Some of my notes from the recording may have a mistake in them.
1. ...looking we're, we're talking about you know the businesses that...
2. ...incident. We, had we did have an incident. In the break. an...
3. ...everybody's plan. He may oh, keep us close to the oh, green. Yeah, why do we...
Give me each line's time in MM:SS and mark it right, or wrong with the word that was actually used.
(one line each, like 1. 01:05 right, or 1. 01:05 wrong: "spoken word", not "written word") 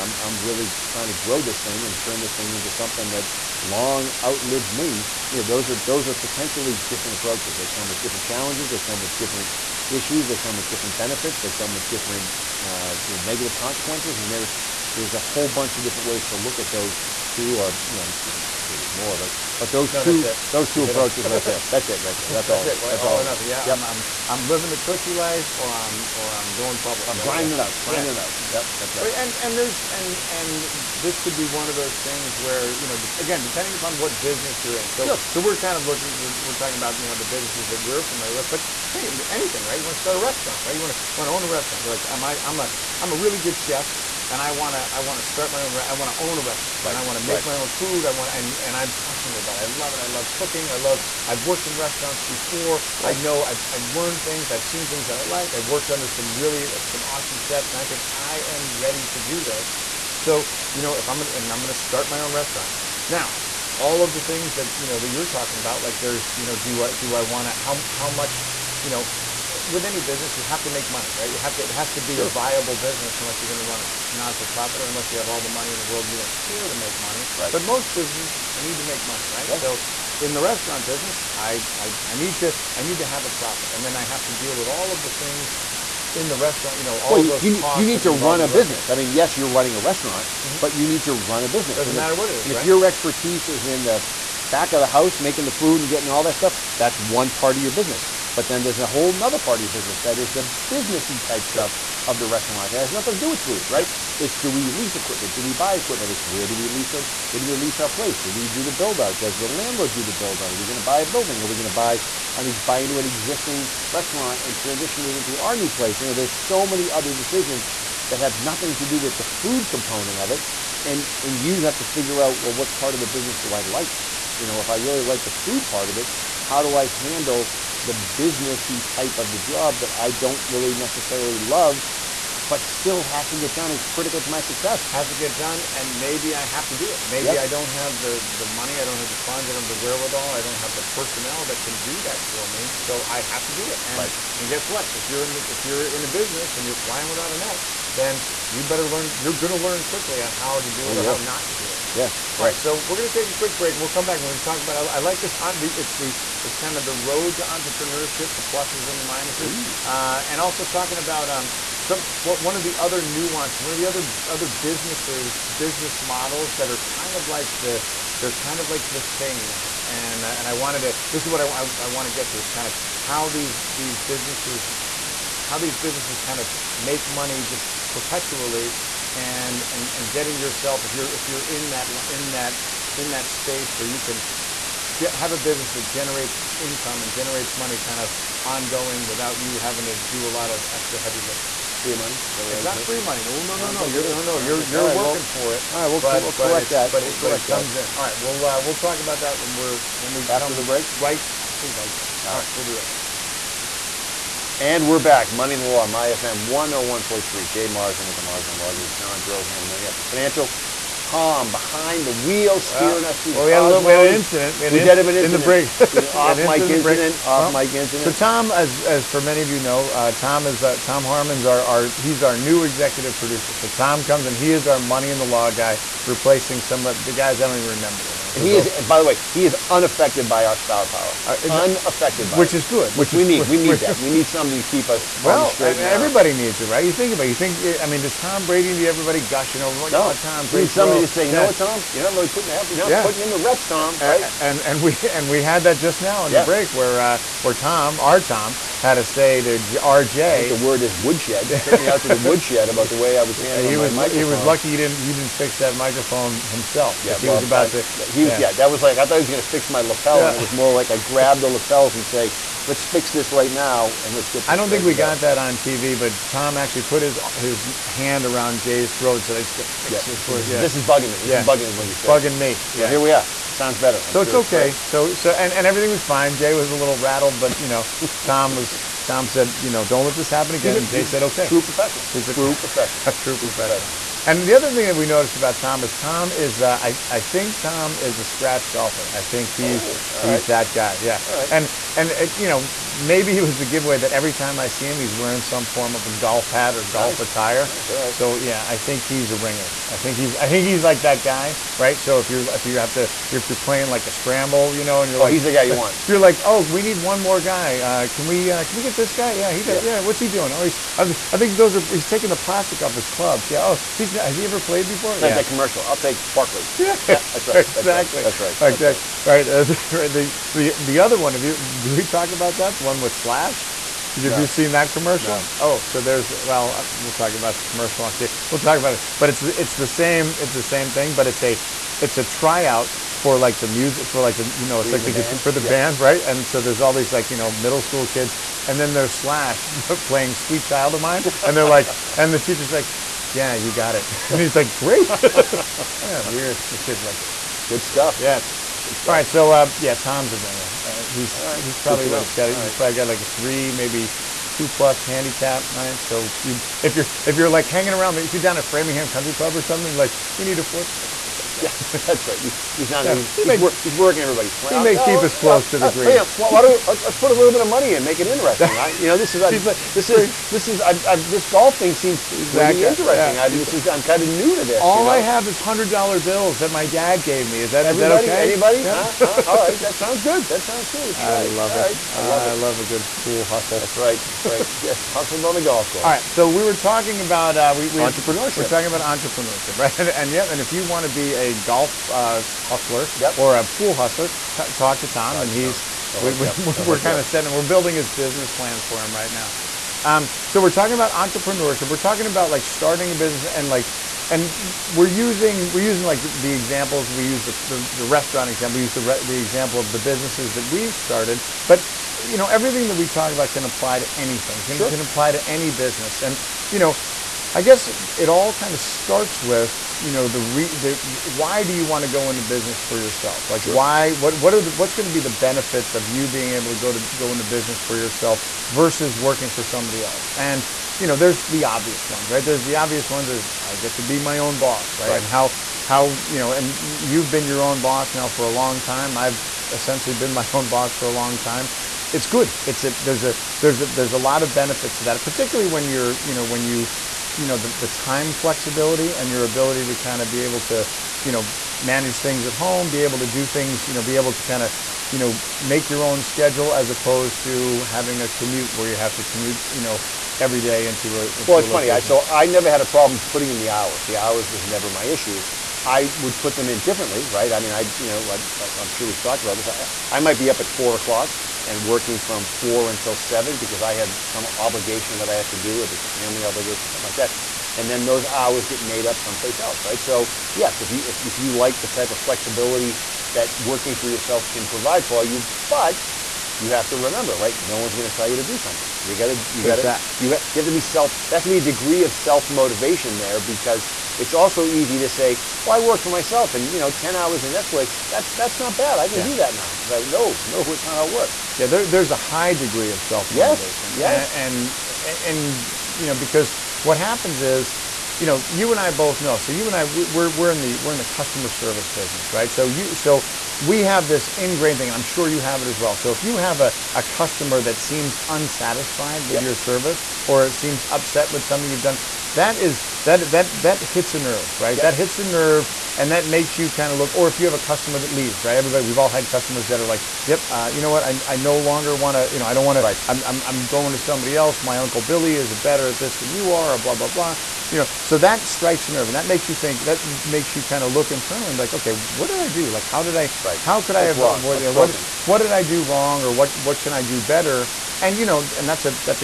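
1. 00:35 right
2. 03:34 right
3. 06:04 right.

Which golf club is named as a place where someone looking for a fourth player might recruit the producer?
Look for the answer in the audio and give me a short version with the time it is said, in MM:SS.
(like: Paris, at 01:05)
Framingham Country Club, at 05:58.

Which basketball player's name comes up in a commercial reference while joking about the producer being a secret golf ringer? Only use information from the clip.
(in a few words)
Barkley.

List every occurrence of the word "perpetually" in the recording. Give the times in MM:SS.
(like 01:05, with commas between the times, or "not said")
02:57.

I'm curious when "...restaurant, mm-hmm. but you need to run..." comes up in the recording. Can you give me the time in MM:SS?
01:29.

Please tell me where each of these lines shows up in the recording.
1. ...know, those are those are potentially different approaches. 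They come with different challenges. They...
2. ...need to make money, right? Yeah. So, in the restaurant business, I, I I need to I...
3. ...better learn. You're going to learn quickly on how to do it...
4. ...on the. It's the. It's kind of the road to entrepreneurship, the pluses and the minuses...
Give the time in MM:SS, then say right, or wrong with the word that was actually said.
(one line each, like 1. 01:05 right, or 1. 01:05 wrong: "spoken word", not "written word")
1. 00:05 right
2. 01:18 right
3. 02:28 right
4. 02:35 right.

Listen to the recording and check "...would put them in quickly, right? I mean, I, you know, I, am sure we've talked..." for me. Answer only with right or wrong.
wrong.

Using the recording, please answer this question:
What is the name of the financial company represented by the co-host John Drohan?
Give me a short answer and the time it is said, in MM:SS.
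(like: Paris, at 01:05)
Main Effort Financial, at 03:29.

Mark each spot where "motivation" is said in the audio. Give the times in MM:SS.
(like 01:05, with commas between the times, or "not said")
08:12, 08:23.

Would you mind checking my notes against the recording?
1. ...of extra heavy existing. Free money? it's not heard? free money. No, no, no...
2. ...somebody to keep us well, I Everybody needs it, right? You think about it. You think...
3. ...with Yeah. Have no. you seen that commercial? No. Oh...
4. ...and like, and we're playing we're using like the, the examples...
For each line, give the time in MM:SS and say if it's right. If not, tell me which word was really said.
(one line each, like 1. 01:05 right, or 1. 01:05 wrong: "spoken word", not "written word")
1. 03:10 wrong: "lifting", not "existing"
2. 03:54 right
3. 05:22 wrong: "Slash", not "Yeah"
4. 06:43 wrong: "using", not "playing".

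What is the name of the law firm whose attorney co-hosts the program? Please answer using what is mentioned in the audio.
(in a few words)
Marsden Law Group.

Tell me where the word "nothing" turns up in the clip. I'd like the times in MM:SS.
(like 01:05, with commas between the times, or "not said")
00:23, 01:42, 01:58.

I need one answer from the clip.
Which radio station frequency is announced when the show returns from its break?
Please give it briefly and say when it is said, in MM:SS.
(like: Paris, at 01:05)
101.3, at 03:25.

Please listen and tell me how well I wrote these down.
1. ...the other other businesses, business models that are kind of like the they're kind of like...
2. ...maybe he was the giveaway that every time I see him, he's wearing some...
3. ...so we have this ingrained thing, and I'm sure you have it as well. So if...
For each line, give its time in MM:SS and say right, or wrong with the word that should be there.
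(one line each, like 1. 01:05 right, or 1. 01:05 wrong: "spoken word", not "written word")
1. 02:43 right
2. 04:52 right
3. 08:32 right.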